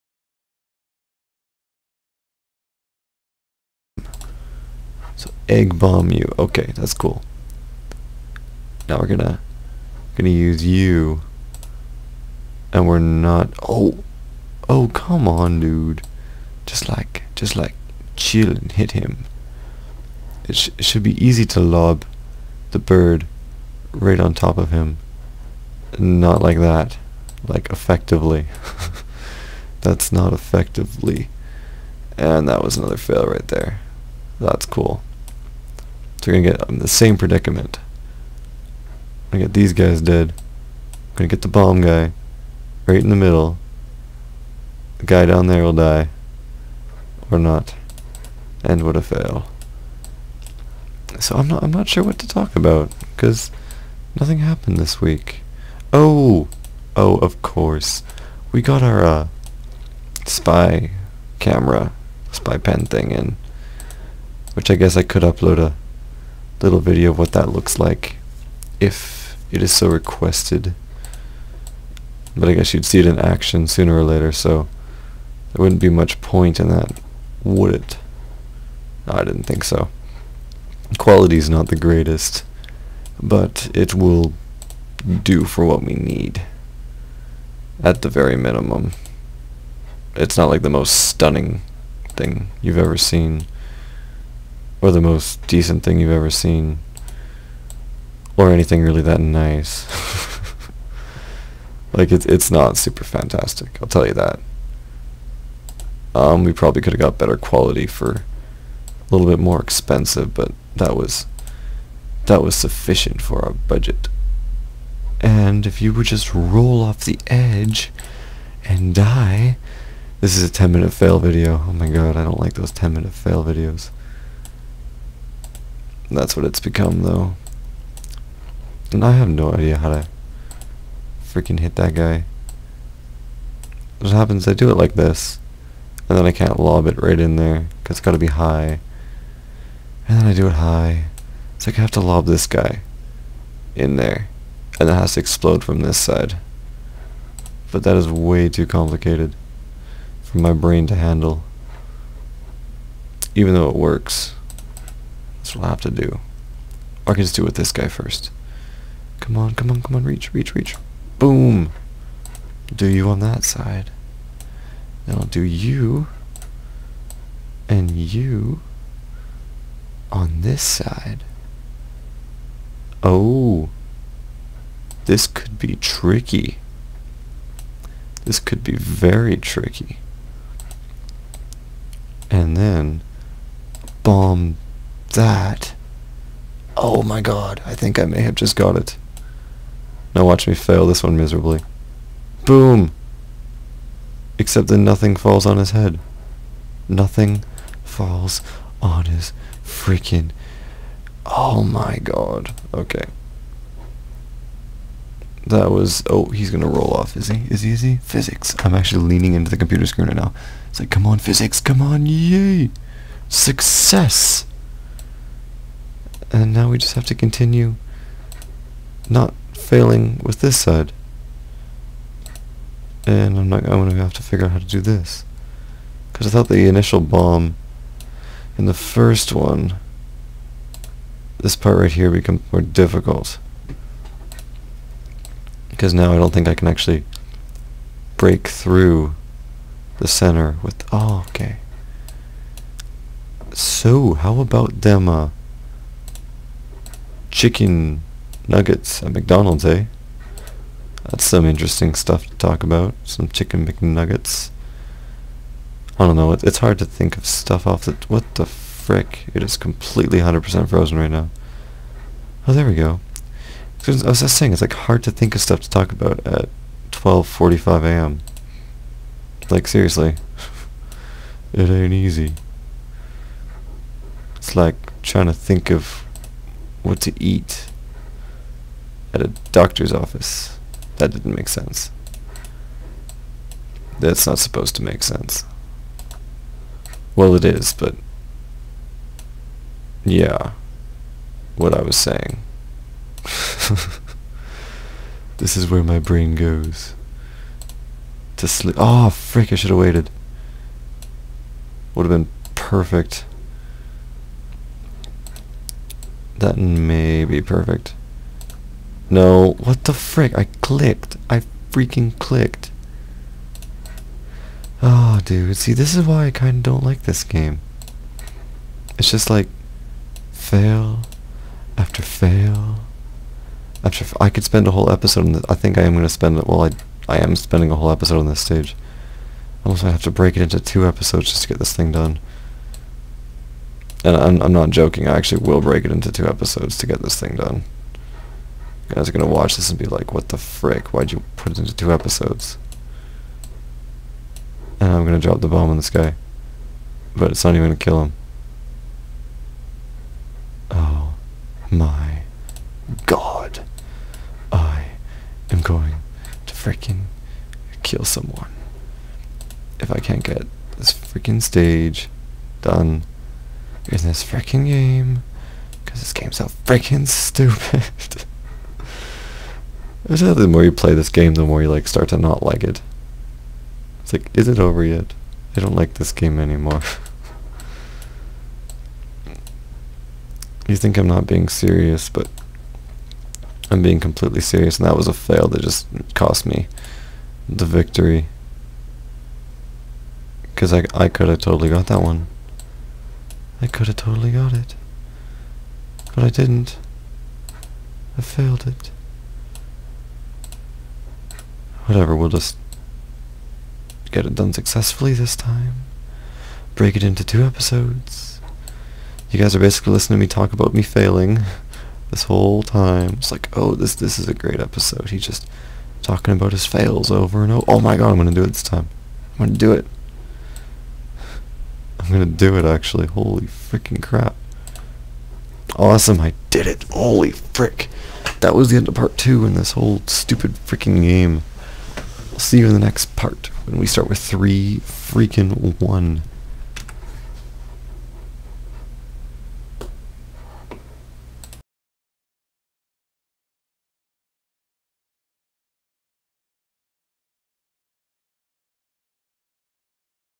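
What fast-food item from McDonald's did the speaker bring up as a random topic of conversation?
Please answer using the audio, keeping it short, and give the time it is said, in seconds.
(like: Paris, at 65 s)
chicken nuggets, at 247 s.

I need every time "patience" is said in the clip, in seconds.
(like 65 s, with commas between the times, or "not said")
not said.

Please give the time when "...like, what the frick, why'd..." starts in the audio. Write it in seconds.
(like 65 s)
339 s.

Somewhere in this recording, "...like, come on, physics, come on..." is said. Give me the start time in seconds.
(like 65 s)
210 s.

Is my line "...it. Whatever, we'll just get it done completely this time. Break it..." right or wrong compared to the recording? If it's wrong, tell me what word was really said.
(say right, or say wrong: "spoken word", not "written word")
wrong: "successfully", not "completely".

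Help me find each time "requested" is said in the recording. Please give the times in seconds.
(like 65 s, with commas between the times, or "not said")
69 s.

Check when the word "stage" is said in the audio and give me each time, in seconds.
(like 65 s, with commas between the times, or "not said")
328 s, 361 s.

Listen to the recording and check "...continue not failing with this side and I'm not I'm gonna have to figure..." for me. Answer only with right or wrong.
right.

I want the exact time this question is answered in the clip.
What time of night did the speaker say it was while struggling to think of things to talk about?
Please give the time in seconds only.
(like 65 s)
266 s.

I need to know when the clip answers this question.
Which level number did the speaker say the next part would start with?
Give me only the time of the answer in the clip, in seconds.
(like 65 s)
434 s.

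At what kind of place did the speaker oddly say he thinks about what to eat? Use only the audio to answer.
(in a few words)
a doctor's office.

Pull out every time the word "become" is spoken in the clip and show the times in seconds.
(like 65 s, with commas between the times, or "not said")
126 s, 232 s.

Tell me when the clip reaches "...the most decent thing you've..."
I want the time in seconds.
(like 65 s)
94 s.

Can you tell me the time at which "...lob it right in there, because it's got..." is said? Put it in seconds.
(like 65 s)
136 s.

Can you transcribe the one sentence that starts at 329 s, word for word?
Almost I have to break it into two episodes just to get this thing done.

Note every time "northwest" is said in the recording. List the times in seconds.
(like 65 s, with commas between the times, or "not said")
not said.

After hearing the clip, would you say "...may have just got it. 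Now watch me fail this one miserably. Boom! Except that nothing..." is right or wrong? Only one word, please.
right.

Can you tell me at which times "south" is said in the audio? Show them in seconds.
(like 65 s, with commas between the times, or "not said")
not said.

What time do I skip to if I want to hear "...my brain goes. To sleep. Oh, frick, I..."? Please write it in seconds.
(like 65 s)
295 s.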